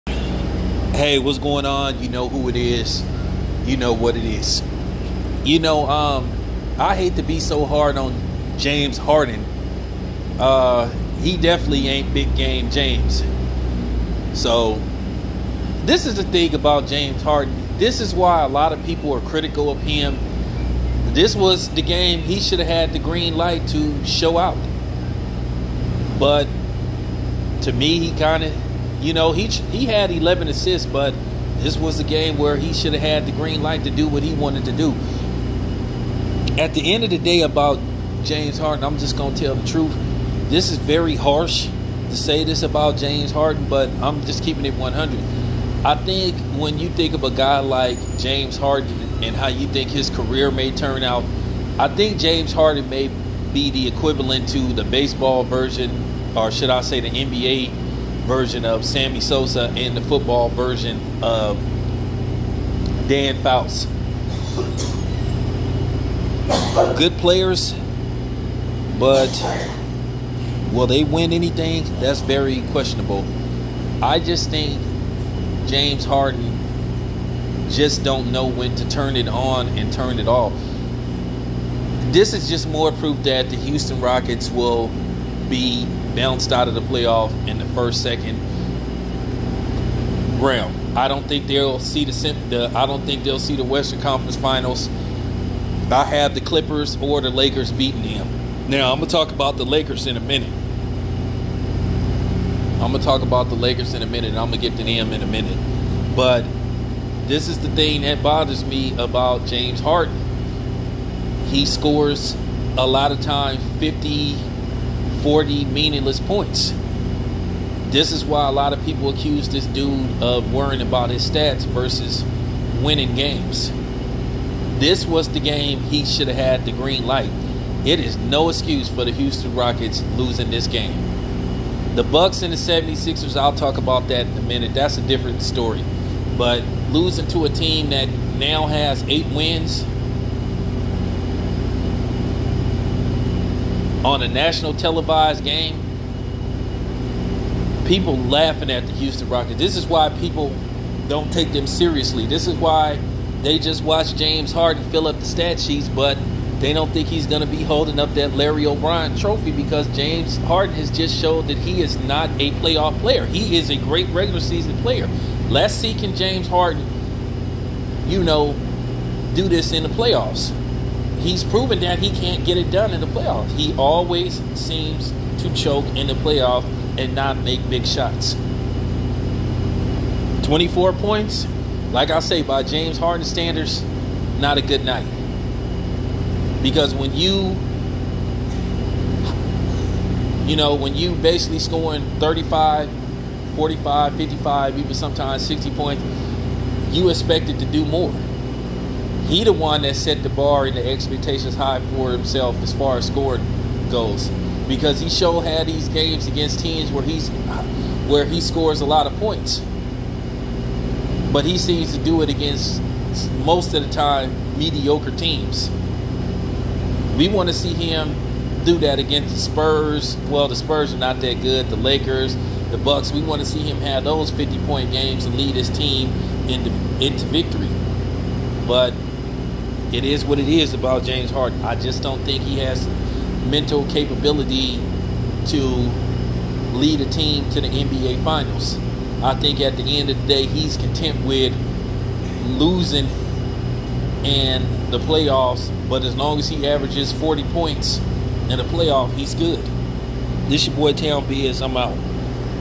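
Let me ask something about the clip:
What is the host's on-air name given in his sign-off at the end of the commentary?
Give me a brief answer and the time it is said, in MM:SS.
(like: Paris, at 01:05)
Town Biz, at 04:10.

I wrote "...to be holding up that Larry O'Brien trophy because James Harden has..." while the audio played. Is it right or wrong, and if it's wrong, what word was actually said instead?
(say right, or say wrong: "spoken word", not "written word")
right.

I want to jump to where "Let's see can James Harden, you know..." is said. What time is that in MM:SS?
02:45.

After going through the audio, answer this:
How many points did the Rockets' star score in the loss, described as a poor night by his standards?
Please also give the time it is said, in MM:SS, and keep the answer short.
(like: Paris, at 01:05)
24, at 03:00.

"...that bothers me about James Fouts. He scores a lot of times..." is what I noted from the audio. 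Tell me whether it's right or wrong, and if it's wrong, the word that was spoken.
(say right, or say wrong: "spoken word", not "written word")
wrong: "Harden", not "Fouts".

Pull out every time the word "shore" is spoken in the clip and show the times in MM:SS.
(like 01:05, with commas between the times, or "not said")
not said.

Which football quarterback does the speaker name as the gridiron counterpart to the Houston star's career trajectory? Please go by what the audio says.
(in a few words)
Dan Fouts.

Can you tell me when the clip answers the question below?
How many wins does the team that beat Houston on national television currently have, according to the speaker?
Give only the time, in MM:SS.
02:19.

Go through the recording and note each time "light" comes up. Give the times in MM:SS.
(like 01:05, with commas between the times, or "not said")
00:23, 00:33, 02:07.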